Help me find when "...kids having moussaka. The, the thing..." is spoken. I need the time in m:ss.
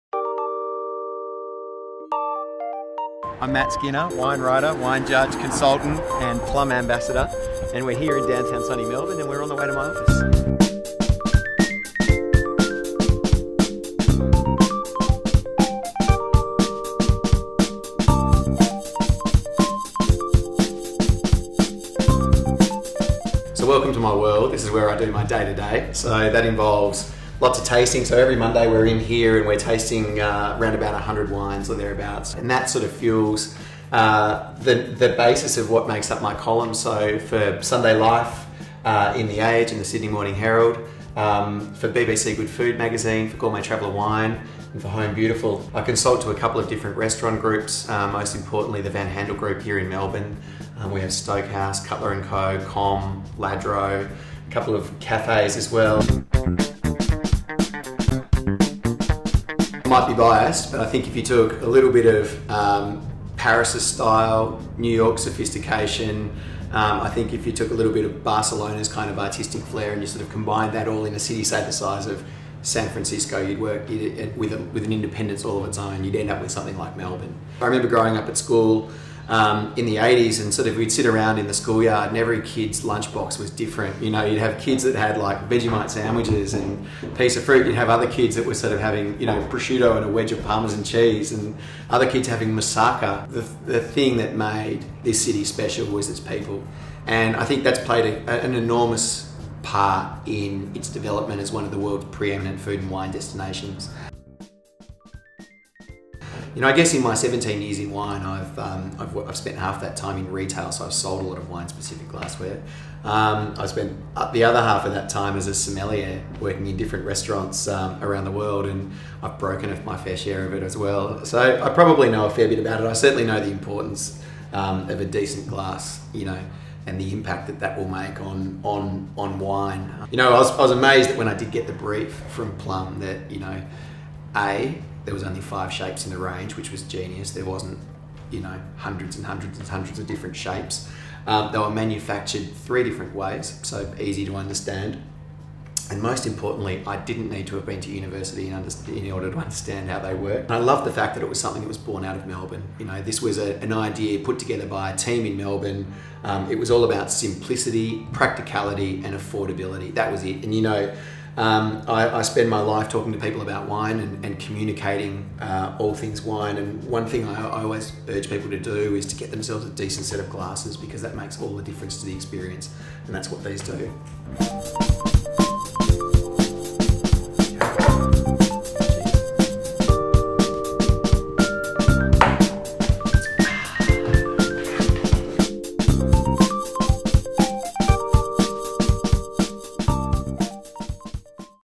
1:32.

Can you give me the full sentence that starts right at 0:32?
And that sort of fuels uh, the, the basis of what makes up my column.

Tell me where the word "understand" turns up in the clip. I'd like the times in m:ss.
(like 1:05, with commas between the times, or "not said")
2:24, 2:29.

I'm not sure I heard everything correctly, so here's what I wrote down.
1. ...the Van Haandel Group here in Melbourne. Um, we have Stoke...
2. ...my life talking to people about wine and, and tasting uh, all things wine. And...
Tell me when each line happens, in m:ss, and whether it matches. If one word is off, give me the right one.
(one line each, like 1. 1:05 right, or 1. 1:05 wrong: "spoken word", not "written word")
1. 0:48 right
2. 2:42 wrong: "communicating", not "tasting".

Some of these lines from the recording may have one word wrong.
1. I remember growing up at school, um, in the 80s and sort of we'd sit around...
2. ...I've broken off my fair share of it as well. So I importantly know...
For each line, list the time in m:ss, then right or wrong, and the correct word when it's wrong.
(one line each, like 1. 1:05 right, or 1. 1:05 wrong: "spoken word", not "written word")
1. 1:17 right
2. 1:59 wrong: "probably", not "importantly".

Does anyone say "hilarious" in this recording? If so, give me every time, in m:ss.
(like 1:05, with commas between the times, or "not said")
not said.